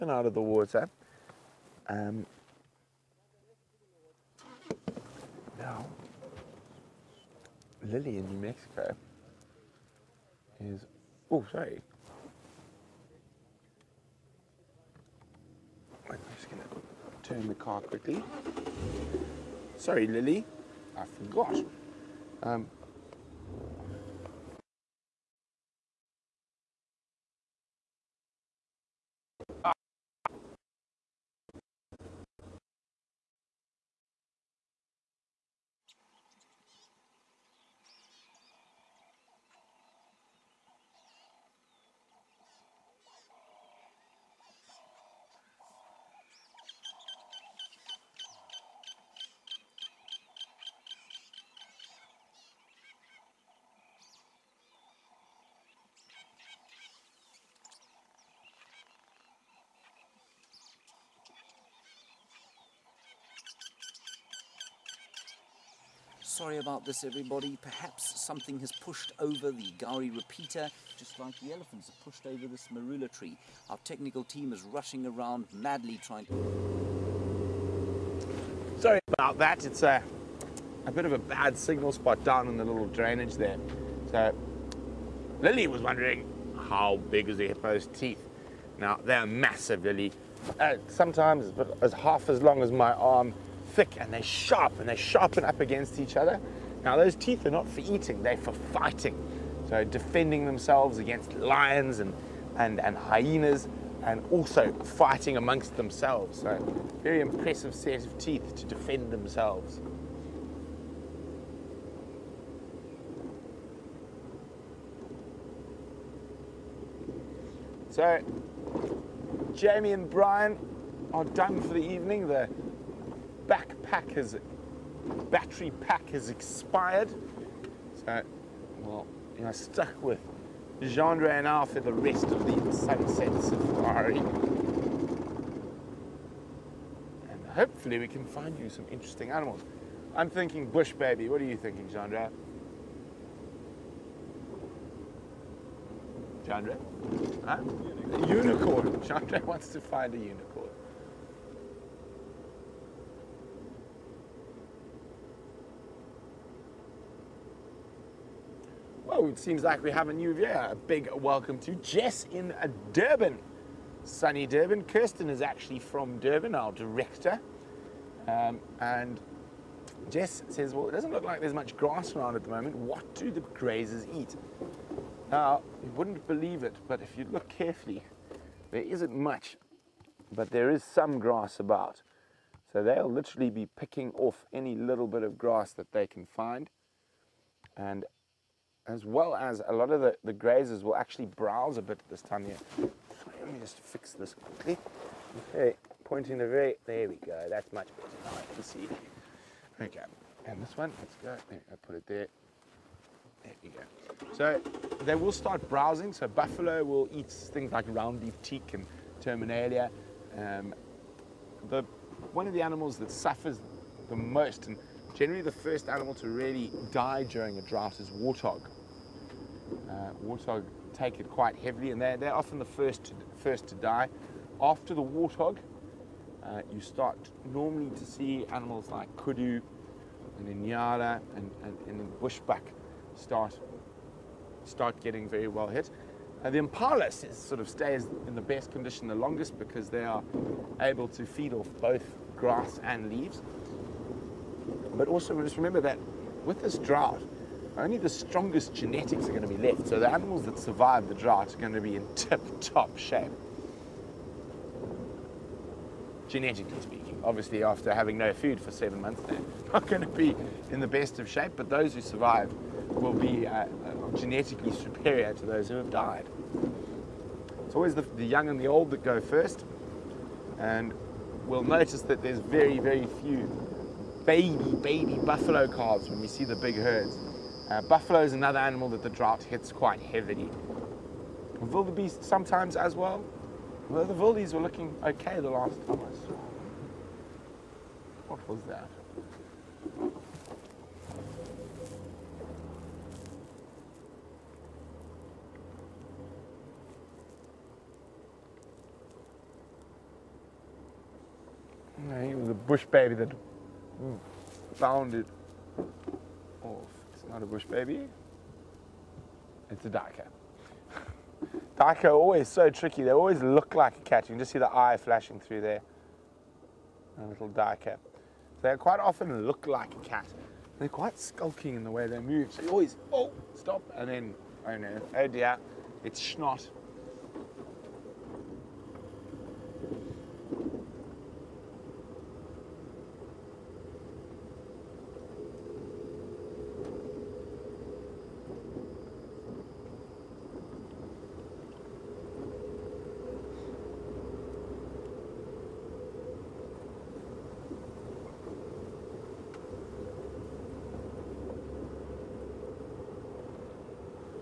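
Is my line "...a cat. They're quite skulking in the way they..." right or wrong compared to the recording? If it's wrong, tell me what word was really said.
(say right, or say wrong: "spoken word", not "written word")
right.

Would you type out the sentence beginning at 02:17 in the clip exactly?
And hopefully we can find you some interesting animals.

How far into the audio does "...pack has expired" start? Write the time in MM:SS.
02:05.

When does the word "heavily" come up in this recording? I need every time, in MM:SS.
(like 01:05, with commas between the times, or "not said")
03:41, 04:39.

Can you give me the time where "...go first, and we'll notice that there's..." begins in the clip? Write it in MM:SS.
04:29.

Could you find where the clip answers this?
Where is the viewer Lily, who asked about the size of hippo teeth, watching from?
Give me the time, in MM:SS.
00:08.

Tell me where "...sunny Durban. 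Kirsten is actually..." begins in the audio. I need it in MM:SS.
02:44.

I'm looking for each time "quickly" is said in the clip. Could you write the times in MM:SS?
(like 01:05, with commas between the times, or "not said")
00:17, 03:14.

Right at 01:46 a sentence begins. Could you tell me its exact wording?
So very impressive set of teeth to defend themselves.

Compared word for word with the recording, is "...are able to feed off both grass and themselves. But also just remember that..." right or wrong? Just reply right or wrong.
wrong.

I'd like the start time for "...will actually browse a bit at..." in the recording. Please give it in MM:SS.
03:10.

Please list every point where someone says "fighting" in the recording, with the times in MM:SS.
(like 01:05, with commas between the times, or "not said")
01:38, 01:44.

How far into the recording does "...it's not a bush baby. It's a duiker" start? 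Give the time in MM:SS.
05:07.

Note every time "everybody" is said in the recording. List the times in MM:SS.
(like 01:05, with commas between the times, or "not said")
01:07.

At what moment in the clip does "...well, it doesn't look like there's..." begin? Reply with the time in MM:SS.
02:50.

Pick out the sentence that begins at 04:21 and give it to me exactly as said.
But those who survive will be uh, uh, genetically superior to those who have died.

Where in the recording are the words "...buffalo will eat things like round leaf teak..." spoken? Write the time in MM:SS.
03:26.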